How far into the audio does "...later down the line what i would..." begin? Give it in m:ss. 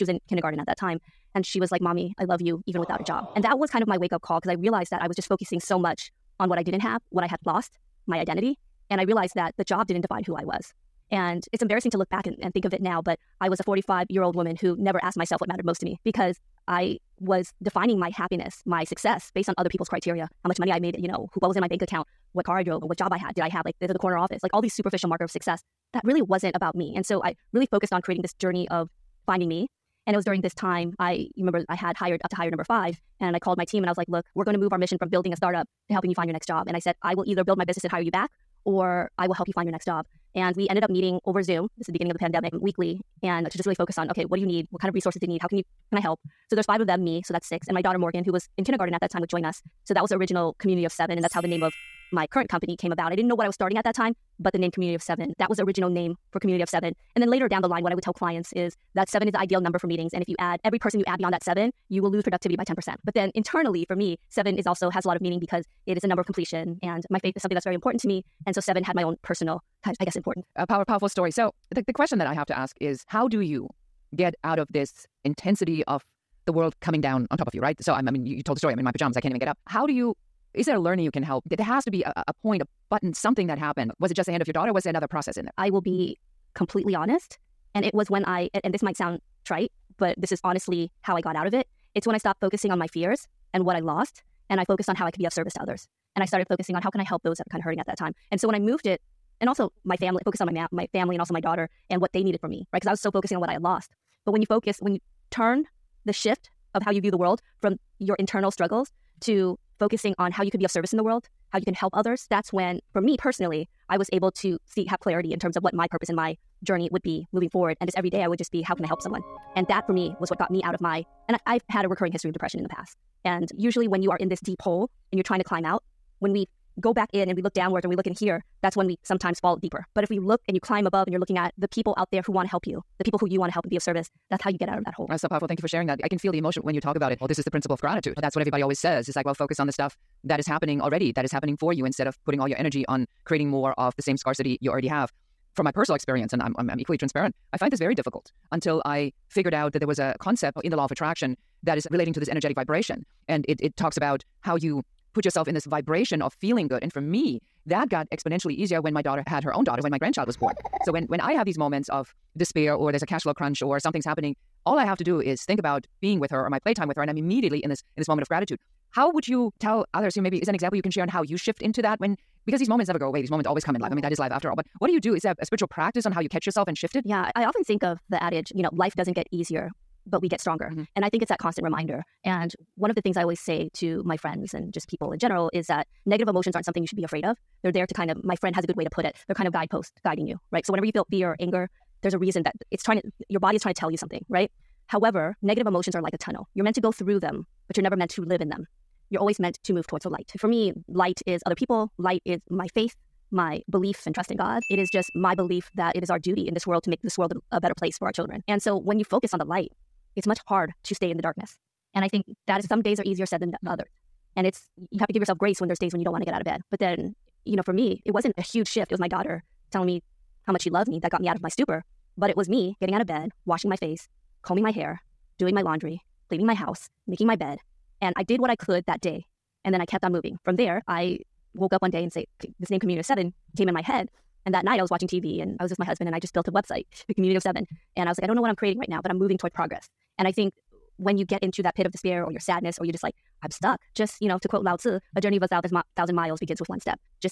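0:57.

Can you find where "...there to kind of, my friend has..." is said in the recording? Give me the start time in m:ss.
3:07.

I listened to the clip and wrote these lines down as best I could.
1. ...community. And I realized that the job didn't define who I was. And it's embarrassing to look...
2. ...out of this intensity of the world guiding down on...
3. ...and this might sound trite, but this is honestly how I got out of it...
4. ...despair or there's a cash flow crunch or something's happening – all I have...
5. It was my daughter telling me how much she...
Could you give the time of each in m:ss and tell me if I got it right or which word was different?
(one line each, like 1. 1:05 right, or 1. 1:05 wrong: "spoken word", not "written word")
1. 0:08 wrong: "identity", not "community"
2. 1:14 wrong: "coming", not "guiding"
3. 1:28 right
4. 2:42 right
5. 3:38 right.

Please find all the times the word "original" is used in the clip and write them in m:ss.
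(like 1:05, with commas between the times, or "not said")
0:50, 0:55.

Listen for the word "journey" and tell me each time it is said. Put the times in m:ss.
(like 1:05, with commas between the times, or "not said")
0:28, 1:56, 4:05.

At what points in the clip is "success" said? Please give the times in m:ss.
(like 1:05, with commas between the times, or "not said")
0:18, 0:25.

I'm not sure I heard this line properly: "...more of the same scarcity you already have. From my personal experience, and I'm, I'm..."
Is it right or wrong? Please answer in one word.
right.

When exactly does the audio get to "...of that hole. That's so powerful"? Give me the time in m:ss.
2:14.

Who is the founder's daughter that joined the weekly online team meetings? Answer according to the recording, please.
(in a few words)
Morgan.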